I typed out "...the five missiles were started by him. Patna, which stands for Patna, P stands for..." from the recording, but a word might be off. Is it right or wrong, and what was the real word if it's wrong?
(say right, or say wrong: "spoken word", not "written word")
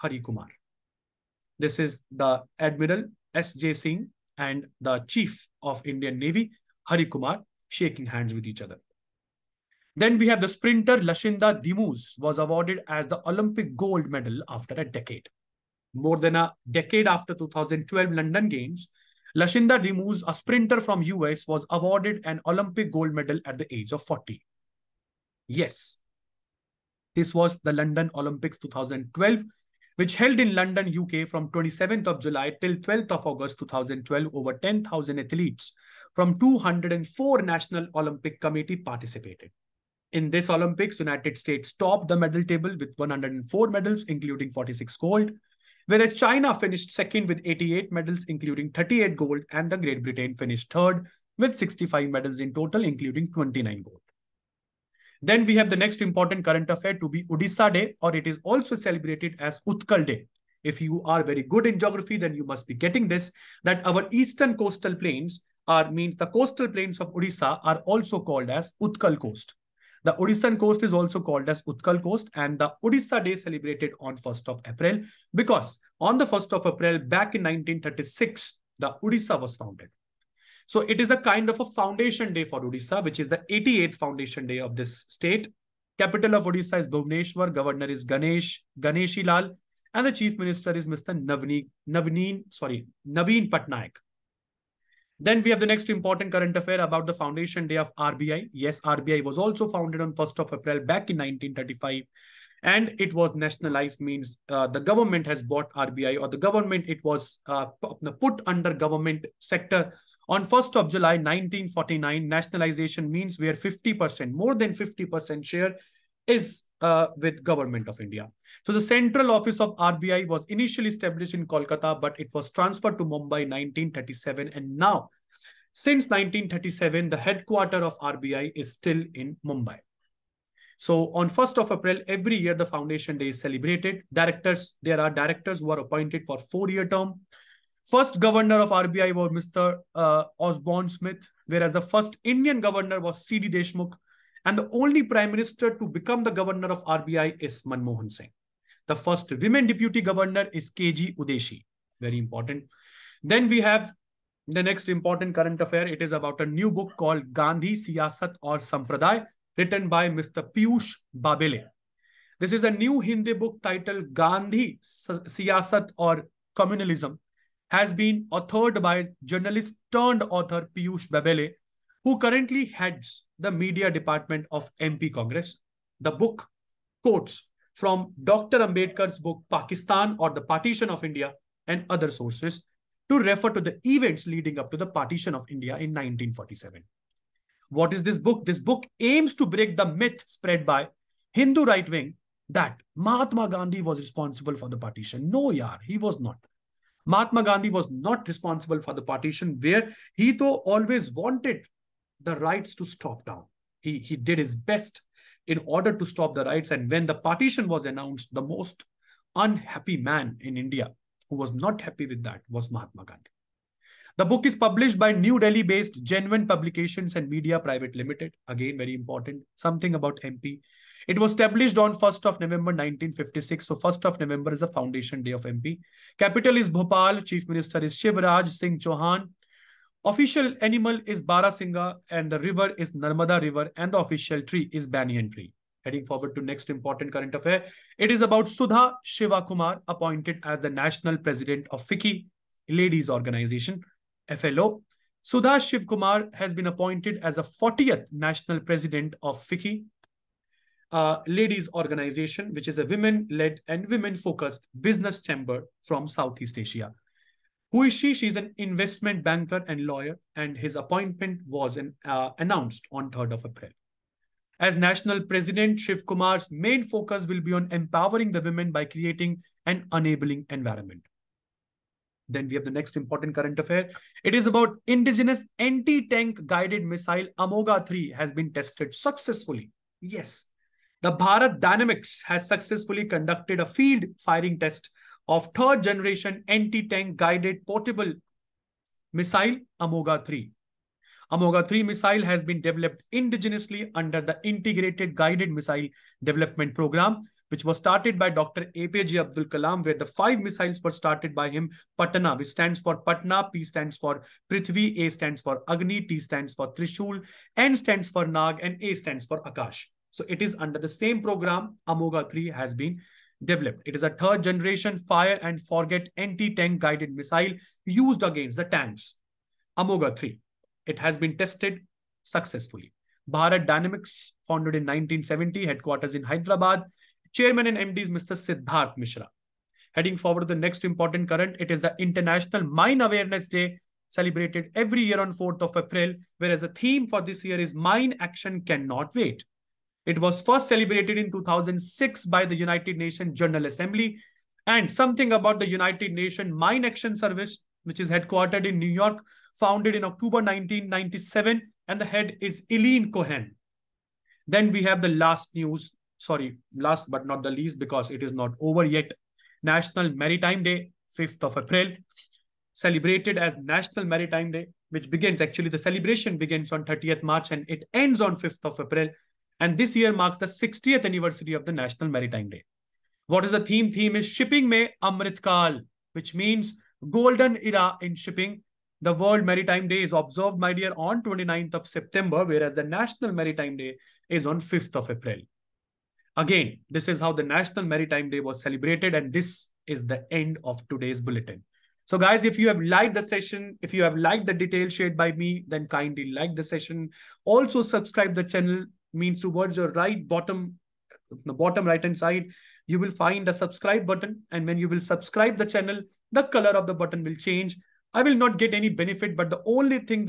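right.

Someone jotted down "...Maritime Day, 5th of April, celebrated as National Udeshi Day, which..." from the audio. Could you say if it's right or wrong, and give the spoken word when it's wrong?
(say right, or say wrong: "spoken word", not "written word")
wrong: "Maritime", not "Udeshi".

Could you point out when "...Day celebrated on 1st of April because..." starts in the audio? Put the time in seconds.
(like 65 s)
73 s.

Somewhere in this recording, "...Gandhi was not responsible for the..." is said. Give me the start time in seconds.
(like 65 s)
197 s.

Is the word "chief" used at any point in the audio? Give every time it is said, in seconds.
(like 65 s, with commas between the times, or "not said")
5 s, 90 s, 227 s.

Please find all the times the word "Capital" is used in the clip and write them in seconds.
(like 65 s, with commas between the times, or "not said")
85 s, 226 s.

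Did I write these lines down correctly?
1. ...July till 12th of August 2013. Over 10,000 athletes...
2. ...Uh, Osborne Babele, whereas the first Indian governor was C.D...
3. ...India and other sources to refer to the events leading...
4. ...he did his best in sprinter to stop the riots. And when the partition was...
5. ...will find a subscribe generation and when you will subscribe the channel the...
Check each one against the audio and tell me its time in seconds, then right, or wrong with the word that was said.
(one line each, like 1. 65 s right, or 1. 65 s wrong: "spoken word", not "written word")
1. 32 s wrong: "2012", not "2013"
2. 139 s wrong: "Smith", not "Babele"
3. 181 s right
4. 203 s wrong: "order", not "sprinter"
5. 402 s wrong: "button", not "generation".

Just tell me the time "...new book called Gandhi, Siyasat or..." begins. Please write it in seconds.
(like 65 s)
156 s.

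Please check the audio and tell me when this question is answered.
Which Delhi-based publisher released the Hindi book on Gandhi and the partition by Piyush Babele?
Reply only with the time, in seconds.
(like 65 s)
216 s.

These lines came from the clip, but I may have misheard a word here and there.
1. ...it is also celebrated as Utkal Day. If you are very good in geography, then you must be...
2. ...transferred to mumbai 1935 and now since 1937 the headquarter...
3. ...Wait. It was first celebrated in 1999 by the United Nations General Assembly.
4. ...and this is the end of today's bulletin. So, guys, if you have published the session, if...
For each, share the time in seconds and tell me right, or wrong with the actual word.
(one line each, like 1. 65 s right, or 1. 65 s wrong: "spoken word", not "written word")
1. 58 s right
2. 122 s wrong: "1937", not "1935"
3. 339 s wrong: "2006", not "1999"
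4. 389 s wrong: "liked", not "published".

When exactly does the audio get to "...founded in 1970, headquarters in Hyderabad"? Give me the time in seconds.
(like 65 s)
324 s.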